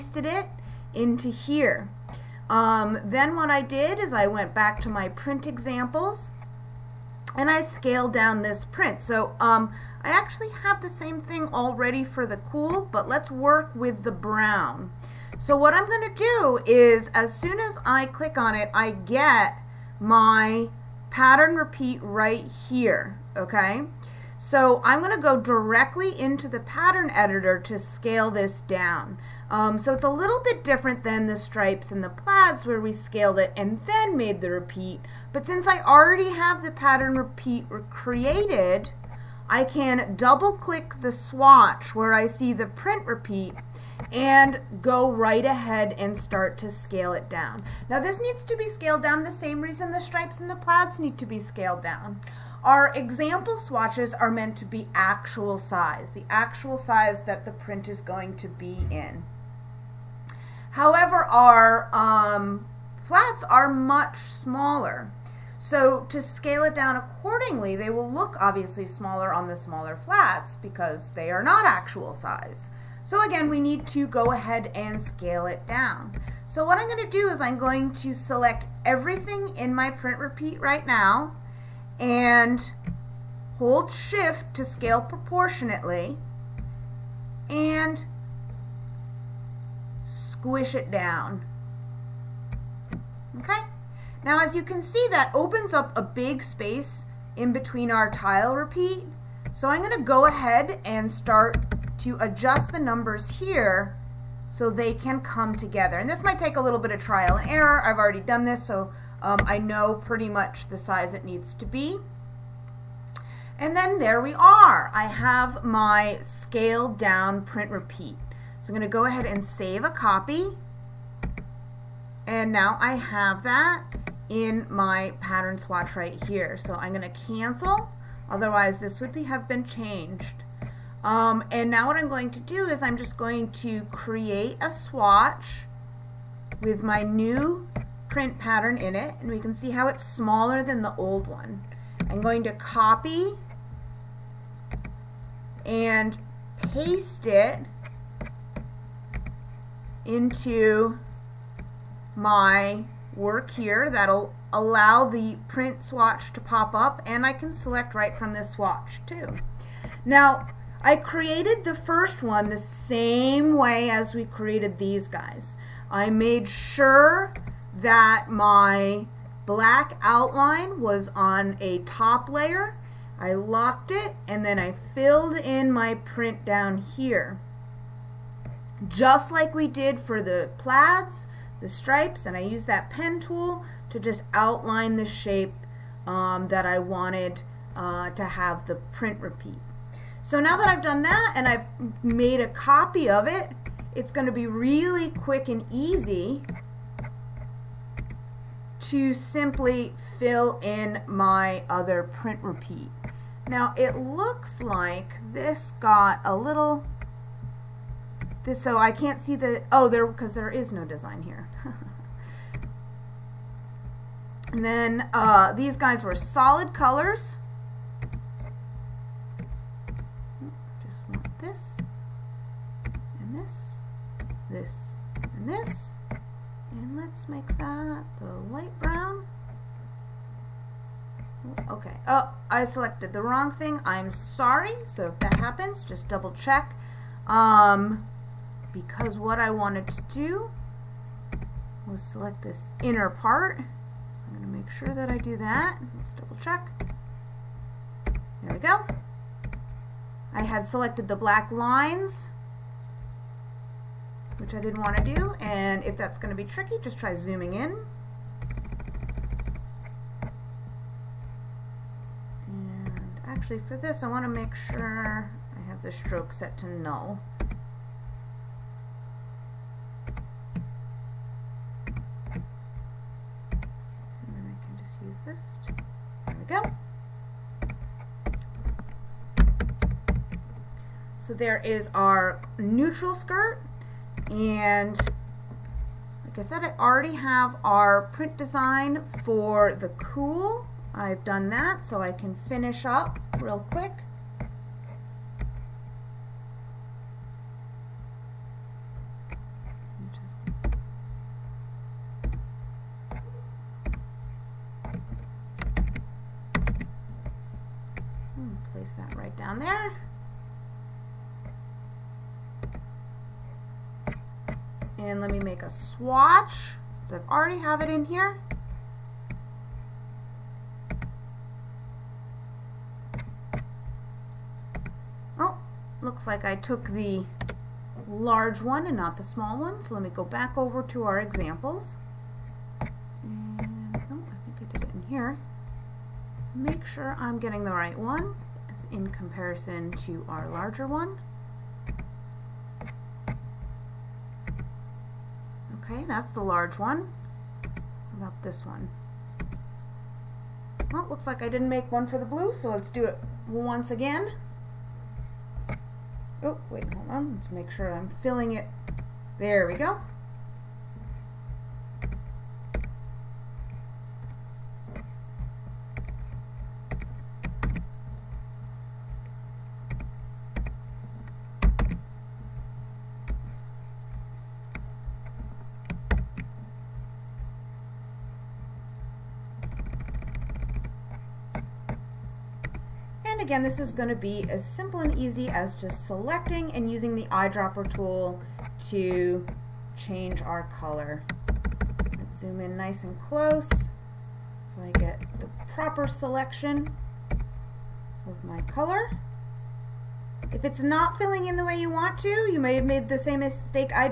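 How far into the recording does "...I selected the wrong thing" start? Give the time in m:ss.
3:52.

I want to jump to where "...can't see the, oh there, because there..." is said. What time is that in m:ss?
3:28.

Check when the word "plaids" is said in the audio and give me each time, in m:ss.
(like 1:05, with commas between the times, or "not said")
0:32, 0:50, 3:00.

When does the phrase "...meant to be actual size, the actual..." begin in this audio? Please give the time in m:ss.
0:54.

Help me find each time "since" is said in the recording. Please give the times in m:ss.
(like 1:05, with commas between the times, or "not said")
0:35, 5:17.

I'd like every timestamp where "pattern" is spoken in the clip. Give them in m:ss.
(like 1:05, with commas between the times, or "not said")
0:21, 0:26, 0:36, 2:05, 2:18.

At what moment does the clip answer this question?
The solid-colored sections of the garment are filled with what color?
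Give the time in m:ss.
3:48.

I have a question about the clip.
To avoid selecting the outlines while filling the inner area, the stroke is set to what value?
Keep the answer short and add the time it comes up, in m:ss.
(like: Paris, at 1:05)
Null, at 4:26.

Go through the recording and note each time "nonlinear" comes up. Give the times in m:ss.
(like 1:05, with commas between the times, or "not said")
not said.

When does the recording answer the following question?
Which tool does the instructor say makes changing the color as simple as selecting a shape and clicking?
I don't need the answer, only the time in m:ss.
6:27.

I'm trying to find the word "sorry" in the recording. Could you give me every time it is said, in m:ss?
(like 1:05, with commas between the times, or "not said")
3:54.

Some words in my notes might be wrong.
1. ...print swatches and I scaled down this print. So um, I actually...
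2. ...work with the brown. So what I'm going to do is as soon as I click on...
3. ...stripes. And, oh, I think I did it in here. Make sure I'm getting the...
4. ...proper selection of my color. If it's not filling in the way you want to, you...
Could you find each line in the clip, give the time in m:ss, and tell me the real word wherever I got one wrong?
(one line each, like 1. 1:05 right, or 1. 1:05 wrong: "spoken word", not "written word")
1. 0:05 wrong: "examples", not "swatches"
2. 0:13 right
3. 5:31 wrong: "examples", not "stripes"
4. 6:35 right.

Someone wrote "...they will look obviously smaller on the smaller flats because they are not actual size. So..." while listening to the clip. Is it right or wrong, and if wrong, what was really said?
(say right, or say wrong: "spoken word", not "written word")
right.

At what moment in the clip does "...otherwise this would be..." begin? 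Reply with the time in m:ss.
2:08.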